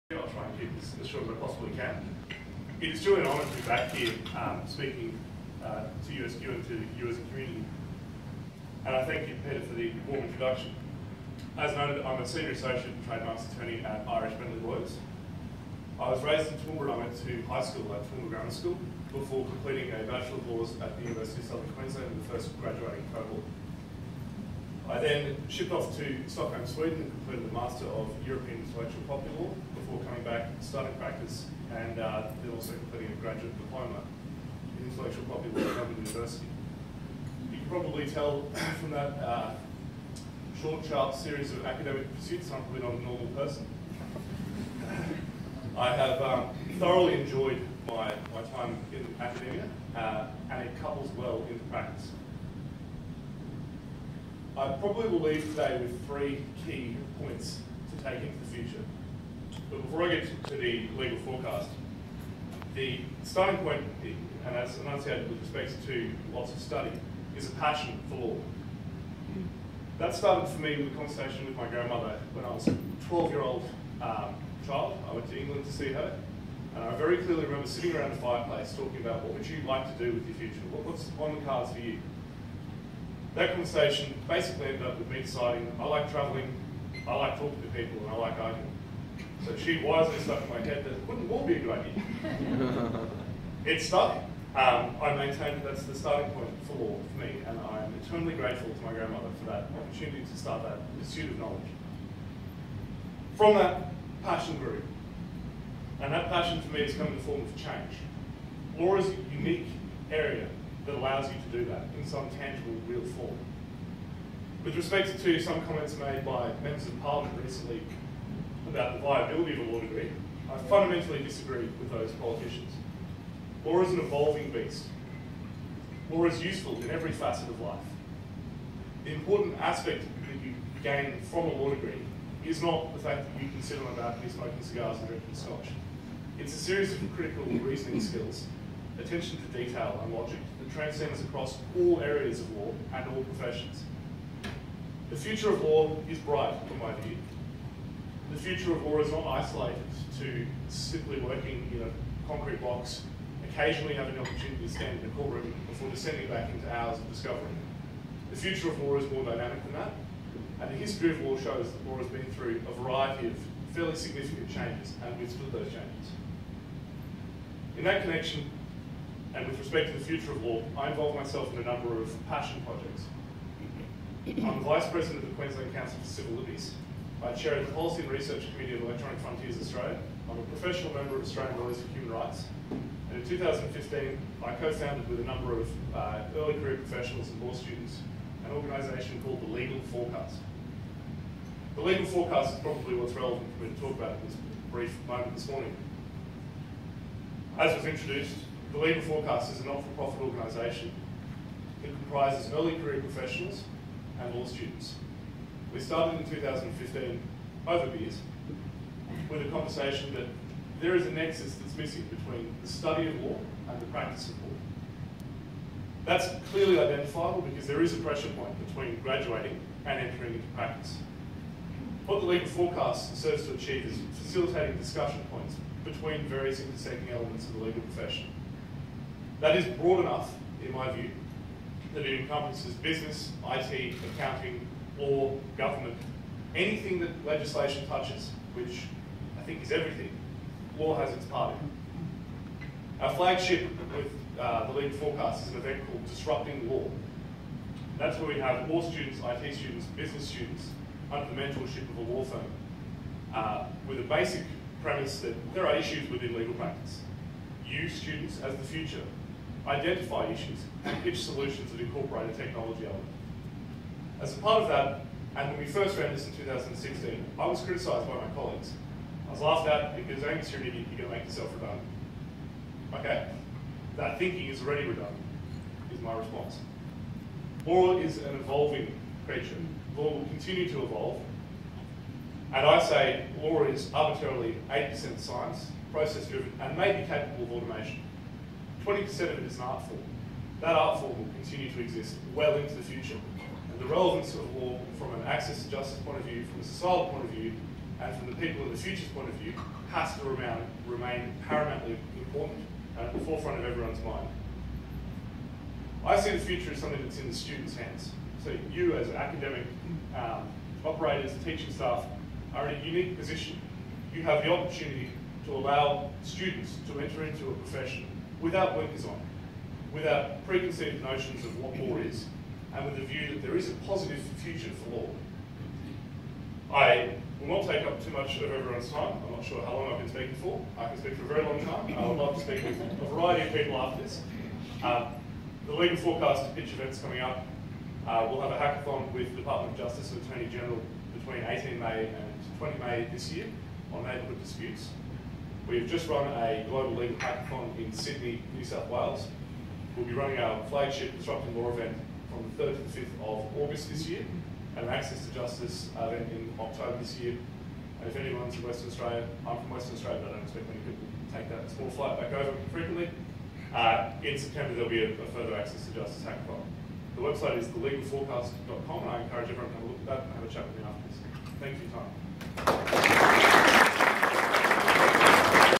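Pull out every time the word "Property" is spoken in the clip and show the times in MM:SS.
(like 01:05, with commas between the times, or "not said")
00:29, 00:35.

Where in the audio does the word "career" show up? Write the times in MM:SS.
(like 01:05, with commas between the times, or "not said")
03:06, 03:22.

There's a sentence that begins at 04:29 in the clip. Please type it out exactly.
I was laughed at because Amy Serenity, you're going to make yourself redundant.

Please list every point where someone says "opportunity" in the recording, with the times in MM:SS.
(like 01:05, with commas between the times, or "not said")
01:39, 02:34, 05:14.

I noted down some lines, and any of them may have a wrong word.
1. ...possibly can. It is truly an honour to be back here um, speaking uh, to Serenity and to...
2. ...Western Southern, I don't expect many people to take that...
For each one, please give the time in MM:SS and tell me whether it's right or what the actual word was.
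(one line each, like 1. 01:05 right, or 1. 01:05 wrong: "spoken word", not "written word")
1. 00:01 wrong: "USQ", not "Serenity"
2. 05:59 wrong: "Australia", not "Southern".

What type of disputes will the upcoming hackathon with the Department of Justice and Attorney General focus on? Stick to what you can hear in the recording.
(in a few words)
Neighbourhood disputes.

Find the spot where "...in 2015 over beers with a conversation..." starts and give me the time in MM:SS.
03:26.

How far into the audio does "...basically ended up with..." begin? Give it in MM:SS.
01:24.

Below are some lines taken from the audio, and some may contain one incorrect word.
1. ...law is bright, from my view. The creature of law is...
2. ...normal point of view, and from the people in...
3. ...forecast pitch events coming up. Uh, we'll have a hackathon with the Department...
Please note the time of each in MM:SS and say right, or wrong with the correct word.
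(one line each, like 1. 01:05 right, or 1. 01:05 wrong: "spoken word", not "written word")
1. 02:25 wrong: "future", not "creature"
2. 04:56 wrong: "societal", not "normal"
3. 05:35 right.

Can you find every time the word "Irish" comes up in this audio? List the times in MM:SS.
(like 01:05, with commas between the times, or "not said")
00:14.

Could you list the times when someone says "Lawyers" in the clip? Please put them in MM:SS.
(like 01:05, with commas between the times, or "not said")
00:14, 03:01.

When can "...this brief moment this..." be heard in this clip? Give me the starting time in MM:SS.
03:14.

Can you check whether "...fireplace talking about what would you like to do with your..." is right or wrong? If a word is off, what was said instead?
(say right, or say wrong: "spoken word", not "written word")
right.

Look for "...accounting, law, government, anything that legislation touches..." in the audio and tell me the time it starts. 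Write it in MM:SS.
03:54.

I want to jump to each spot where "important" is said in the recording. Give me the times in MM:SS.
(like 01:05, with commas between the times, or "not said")
02:09, 05:02.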